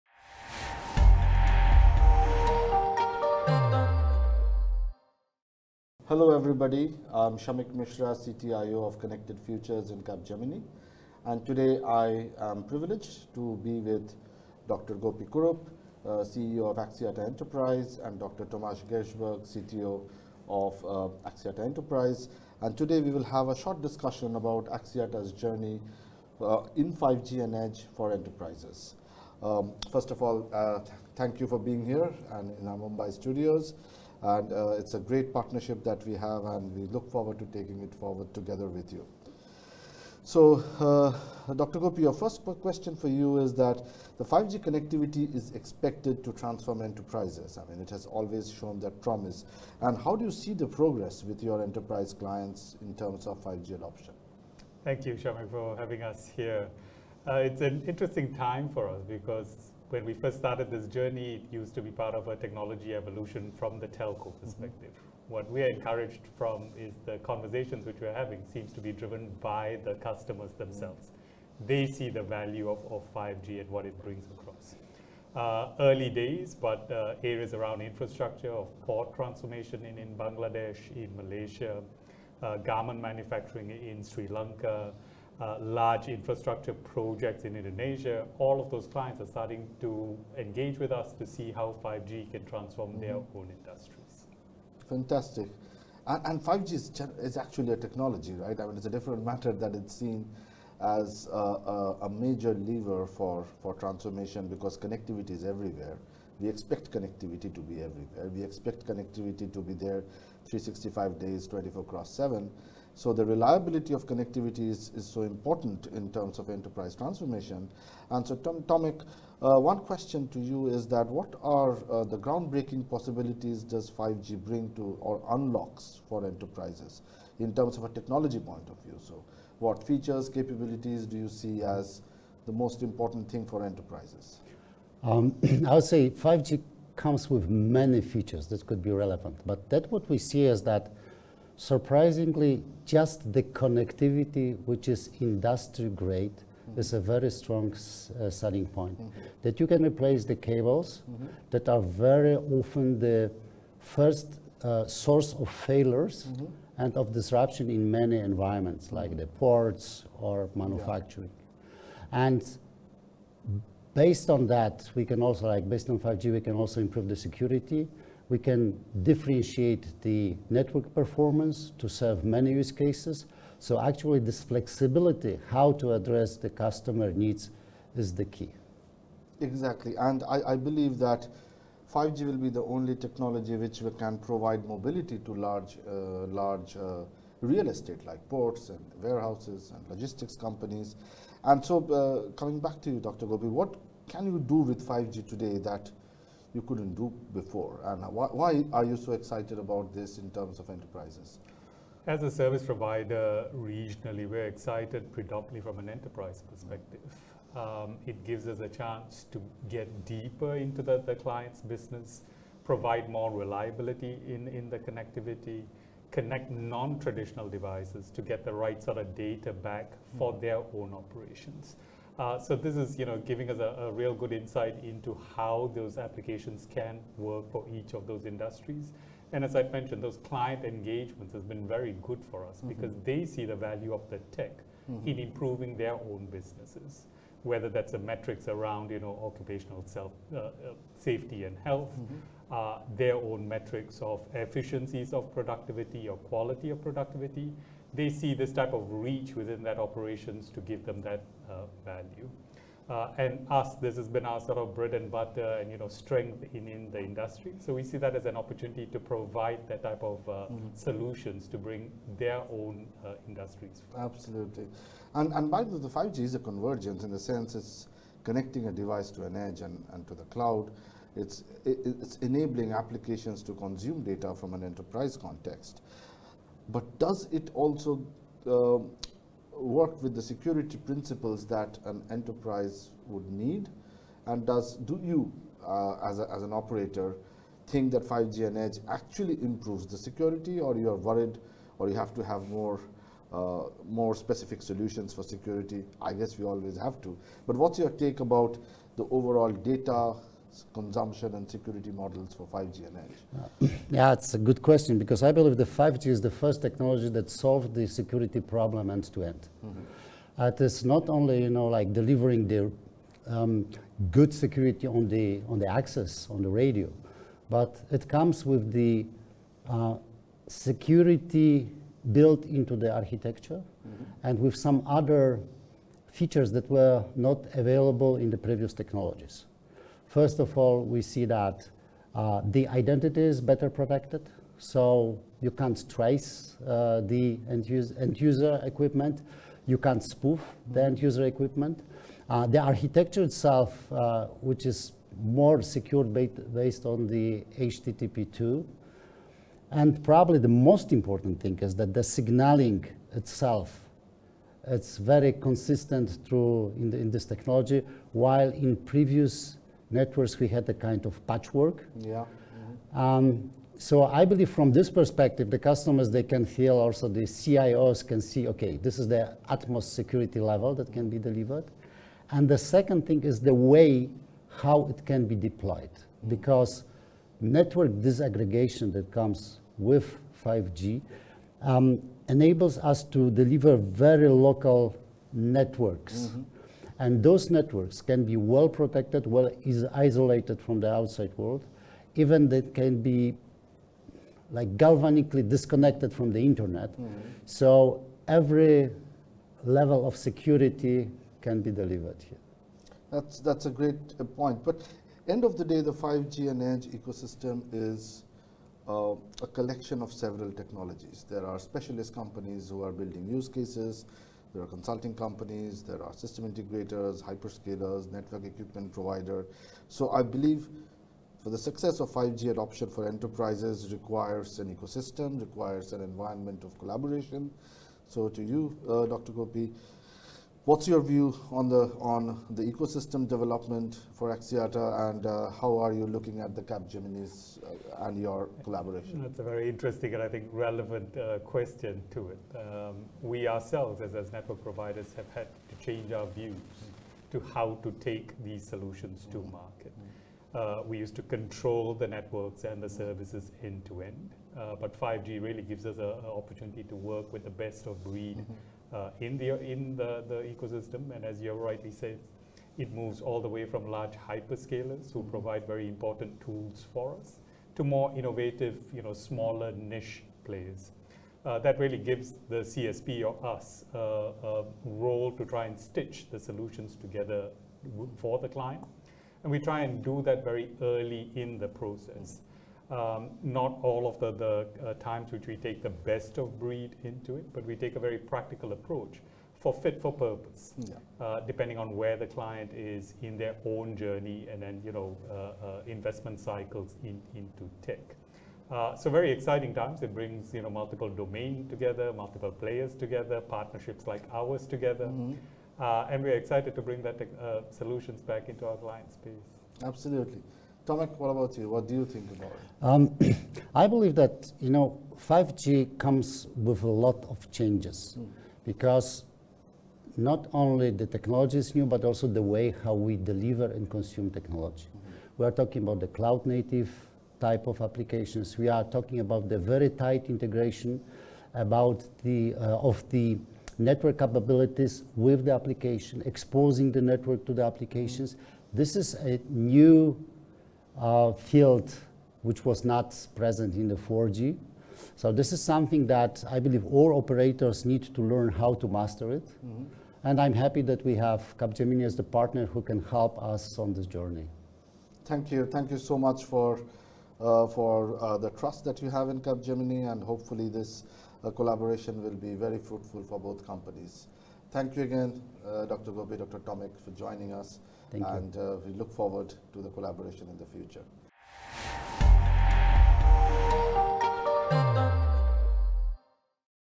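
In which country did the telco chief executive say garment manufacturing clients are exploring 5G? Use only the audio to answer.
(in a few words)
Sri Lanka.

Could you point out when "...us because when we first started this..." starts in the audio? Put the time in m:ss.
0:58.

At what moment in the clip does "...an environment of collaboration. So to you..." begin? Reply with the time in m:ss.
7:05.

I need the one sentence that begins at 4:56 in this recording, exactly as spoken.
I guess we always have to.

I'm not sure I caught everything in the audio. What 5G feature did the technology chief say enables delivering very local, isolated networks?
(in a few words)
Network disaggregation.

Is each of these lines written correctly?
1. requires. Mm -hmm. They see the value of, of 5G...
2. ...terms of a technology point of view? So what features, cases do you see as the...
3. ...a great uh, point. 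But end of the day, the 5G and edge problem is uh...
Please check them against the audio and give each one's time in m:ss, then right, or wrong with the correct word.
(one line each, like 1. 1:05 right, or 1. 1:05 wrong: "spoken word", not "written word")
1. 1:10 wrong: "themselves", not "requires"
2. 2:07 wrong: "capabilities", not "cases"
3. 6:43 wrong: "ecosystem", not "problem".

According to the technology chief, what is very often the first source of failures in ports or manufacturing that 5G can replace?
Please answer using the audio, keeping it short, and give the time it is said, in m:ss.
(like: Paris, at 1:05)
Cables, at 2:30.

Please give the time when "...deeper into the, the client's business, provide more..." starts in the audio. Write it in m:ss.
3:30.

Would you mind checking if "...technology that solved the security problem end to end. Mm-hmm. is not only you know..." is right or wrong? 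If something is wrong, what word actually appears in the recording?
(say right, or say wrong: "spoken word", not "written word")
right.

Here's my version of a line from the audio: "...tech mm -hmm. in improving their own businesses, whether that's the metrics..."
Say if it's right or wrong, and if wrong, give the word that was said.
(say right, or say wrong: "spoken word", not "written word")
right.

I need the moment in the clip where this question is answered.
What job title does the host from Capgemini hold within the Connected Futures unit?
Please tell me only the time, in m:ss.
0:08.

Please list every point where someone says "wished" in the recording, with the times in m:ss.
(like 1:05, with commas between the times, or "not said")
not said.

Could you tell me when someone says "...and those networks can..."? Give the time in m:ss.
6:27.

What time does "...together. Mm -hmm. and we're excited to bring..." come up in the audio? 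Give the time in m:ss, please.
8:24.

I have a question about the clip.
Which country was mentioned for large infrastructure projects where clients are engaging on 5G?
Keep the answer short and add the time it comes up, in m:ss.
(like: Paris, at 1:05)
Indonesia, at 1:27.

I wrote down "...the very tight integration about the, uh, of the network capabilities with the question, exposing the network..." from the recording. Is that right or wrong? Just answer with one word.
wrong.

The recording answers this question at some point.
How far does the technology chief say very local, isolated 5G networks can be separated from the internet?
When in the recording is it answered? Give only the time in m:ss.
6:34.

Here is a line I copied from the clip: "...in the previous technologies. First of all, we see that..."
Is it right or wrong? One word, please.
right.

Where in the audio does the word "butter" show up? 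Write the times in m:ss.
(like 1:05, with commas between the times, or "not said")
4:15.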